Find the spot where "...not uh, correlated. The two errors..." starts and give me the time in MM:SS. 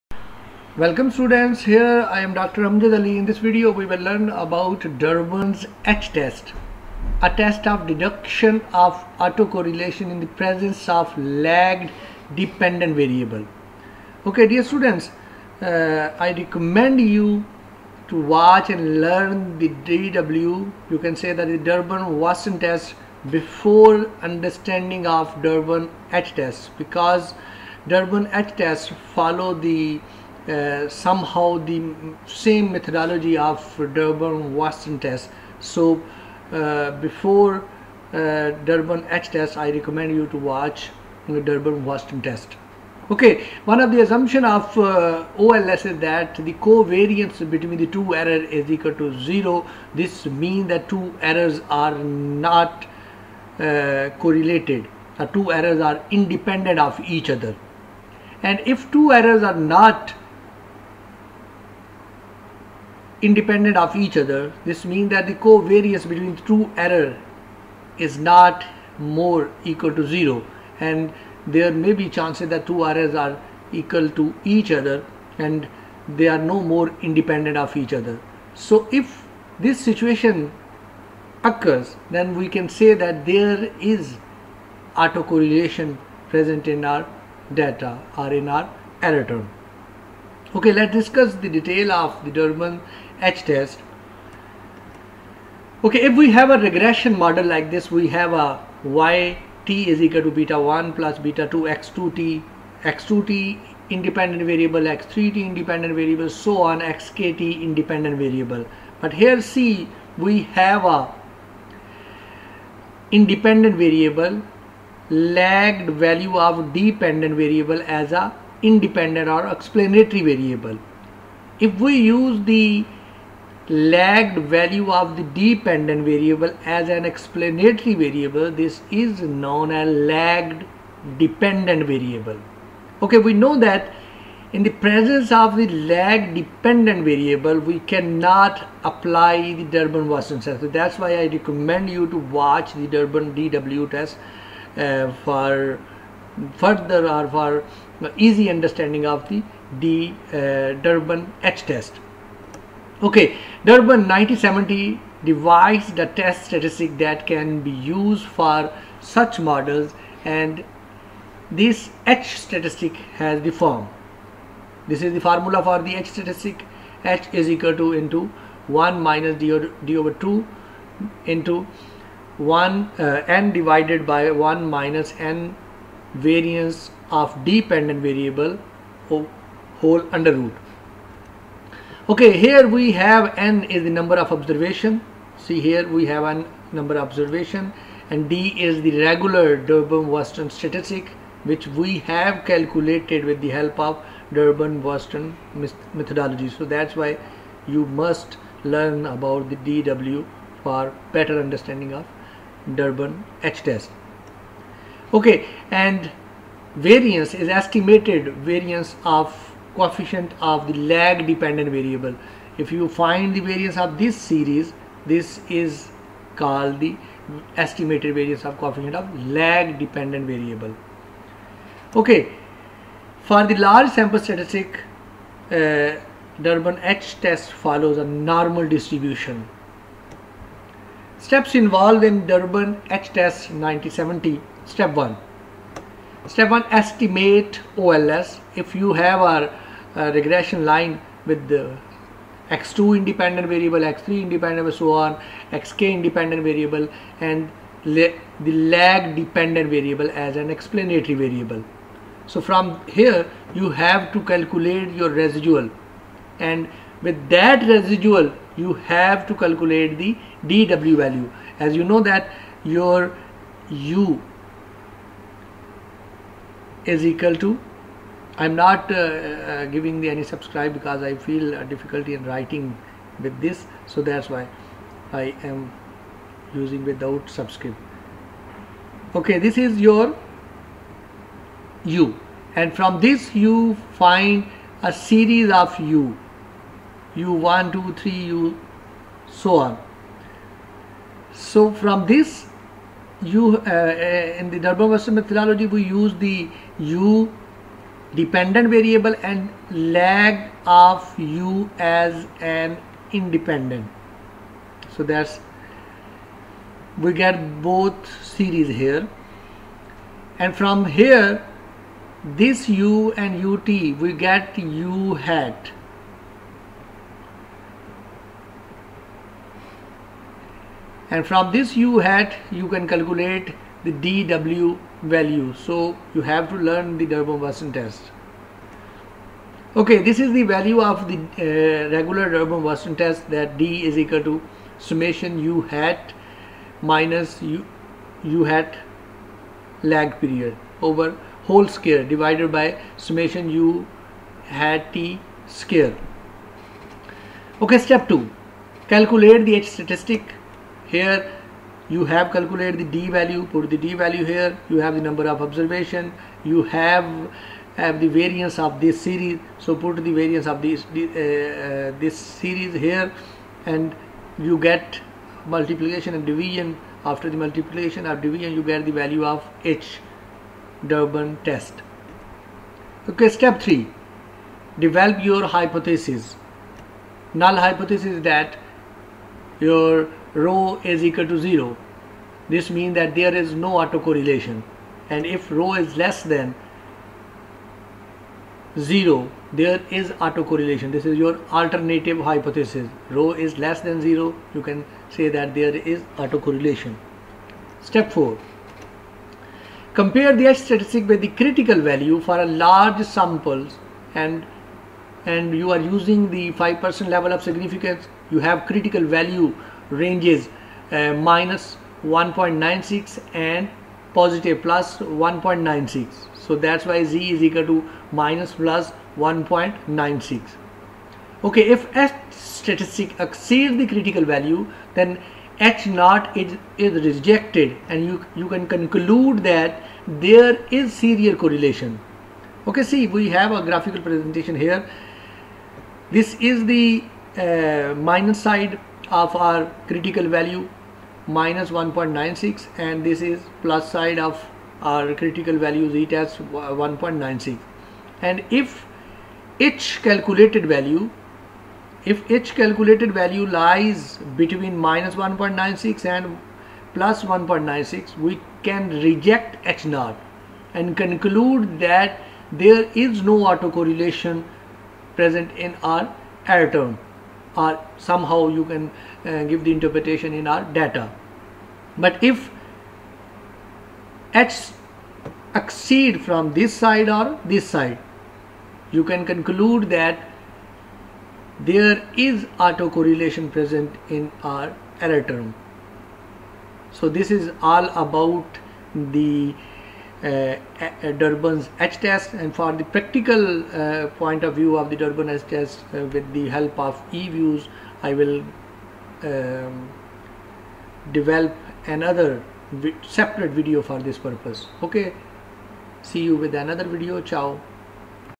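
00:51.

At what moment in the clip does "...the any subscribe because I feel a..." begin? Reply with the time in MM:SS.
04:30.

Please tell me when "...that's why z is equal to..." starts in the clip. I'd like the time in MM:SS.
06:56.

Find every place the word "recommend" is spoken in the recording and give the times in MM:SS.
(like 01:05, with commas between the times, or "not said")
00:16, 00:39, 02:21.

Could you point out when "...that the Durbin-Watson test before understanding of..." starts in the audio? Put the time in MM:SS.
00:21.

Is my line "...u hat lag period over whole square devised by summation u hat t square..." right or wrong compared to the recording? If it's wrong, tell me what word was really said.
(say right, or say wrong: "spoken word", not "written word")
wrong: "divided", not "devised".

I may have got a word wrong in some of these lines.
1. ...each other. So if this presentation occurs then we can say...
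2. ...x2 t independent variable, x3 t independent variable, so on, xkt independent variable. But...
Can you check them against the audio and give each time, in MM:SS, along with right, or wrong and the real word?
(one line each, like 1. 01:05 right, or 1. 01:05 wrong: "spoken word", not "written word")
1. 01:17 wrong: "situation", not "presentation"
2. 01:42 right.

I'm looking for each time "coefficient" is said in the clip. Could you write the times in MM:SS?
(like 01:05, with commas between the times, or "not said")
03:29, 03:38.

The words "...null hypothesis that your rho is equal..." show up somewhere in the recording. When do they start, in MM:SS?
06:17.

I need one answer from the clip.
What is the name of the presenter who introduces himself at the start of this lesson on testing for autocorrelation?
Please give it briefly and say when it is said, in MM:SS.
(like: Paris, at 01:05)
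Dr. Amjad Ali, at 00:02.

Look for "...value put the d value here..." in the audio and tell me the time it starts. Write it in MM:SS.
05:53.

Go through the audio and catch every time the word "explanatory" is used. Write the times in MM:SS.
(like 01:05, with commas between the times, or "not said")
01:59, 02:07, 04:10.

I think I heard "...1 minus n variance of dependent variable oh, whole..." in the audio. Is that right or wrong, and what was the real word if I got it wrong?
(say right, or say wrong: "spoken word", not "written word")
right.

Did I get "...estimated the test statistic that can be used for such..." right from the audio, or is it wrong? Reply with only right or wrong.
wrong.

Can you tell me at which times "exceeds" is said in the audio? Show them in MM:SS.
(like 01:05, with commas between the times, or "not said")
07:03, 07:55.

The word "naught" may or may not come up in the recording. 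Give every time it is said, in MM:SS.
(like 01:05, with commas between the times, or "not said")
07:05, 07:39.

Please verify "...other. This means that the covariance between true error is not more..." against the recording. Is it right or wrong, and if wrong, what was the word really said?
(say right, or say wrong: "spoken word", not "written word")
right.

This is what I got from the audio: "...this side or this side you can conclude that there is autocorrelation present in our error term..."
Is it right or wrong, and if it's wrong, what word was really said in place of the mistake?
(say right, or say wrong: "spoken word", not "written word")
right.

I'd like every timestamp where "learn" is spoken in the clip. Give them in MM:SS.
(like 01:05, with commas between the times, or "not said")
00:03, 00:19, 03:18, 05:26.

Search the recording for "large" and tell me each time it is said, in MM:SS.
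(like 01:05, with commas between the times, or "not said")
03:43, 06:42.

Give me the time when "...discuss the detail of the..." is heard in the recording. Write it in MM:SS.
01:30.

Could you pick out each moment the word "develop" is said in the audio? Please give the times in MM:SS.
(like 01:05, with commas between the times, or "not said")
06:14, 08:21.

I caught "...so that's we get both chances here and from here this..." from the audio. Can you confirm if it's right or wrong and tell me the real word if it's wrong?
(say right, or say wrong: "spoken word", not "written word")
wrong: "series", not "chances".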